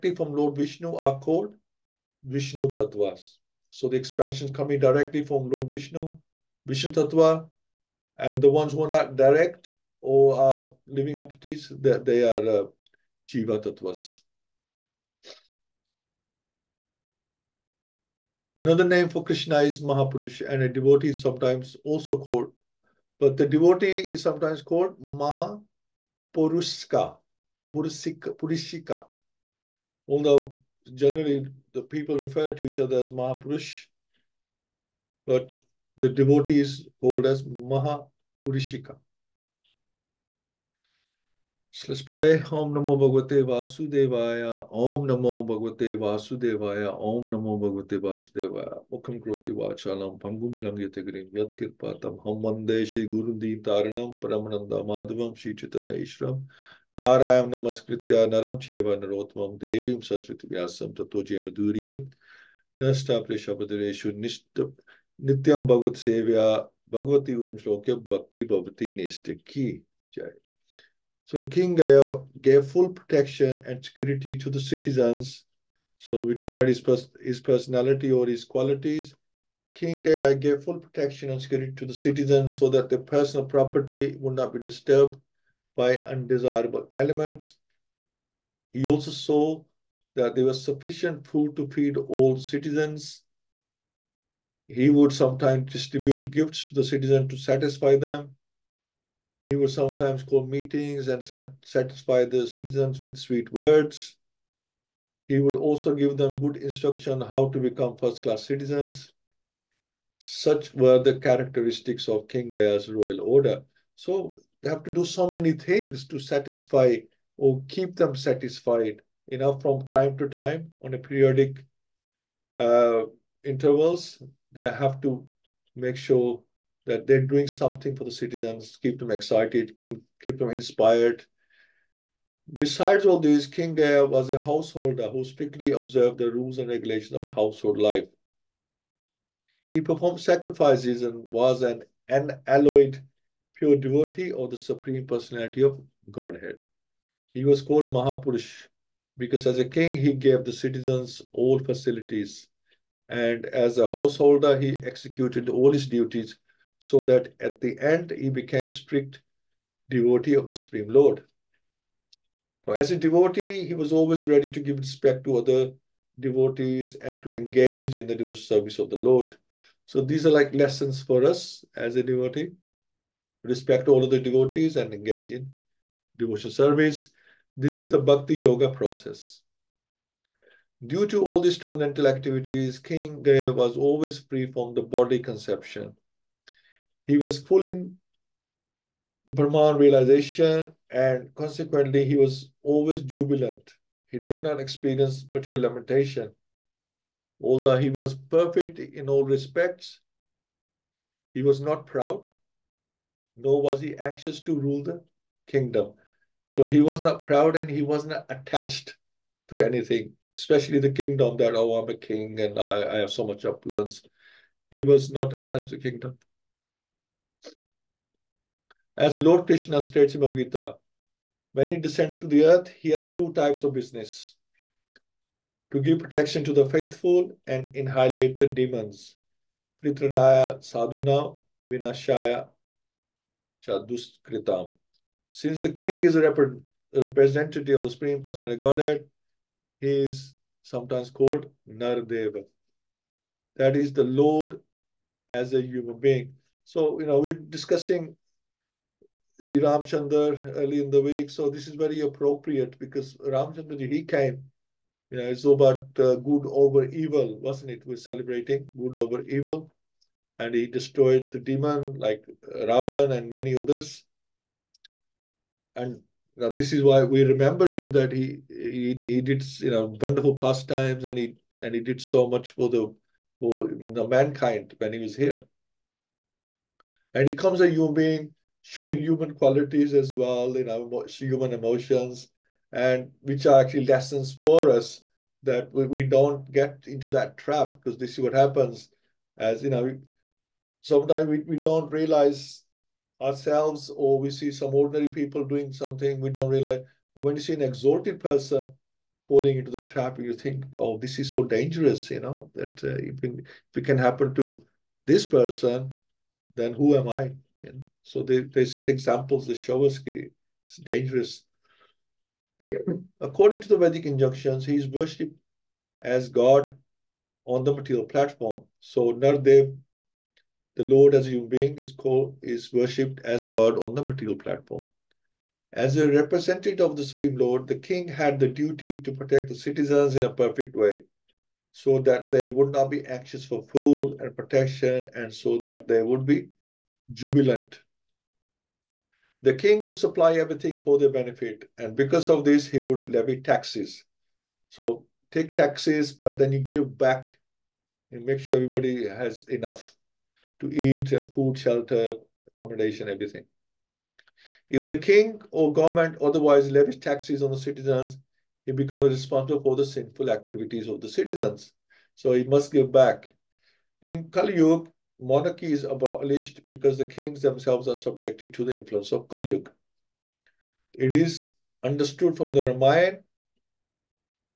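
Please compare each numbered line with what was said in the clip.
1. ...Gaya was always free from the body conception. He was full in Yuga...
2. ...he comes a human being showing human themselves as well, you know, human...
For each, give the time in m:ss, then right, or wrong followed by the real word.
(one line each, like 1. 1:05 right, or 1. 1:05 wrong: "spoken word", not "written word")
1. 3:03 wrong: "Brahman", not "Yuga"
2. 4:37 wrong: "qualities", not "themselves".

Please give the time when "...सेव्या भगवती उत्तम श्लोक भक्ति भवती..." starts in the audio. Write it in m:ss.
1:06.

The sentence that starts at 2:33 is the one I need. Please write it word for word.
And as a householder, he executed all his duties so that at the end, he became strict devotee of the Supreme Lord.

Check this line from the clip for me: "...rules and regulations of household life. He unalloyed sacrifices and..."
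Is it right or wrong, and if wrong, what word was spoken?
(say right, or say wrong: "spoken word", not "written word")
wrong: "performed", not "unalloyed".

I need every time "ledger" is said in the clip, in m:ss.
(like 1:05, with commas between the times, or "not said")
not said.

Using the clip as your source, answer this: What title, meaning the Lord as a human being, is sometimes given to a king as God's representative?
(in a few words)
Nardeva.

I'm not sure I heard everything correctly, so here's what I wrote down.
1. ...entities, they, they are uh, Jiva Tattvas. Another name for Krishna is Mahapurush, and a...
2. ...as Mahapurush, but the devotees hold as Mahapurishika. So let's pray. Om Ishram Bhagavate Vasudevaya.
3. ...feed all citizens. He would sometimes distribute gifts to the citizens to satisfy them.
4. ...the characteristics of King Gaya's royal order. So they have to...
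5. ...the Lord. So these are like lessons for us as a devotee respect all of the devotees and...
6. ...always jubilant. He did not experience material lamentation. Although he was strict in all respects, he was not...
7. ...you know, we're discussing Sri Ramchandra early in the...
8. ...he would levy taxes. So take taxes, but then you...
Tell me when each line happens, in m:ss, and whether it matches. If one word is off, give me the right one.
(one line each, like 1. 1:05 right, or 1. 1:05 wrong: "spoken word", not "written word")
1. 0:11 right
2. 0:32 wrong: "Namo", not "Ishram"
3. 1:31 right
4. 1:51 right
5. 2:48 right
6. 3:12 wrong: "perfect", not "strict"
7. 4:06 right
8. 5:42 right.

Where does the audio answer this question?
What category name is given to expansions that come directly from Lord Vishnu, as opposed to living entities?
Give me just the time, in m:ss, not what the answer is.
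0:02.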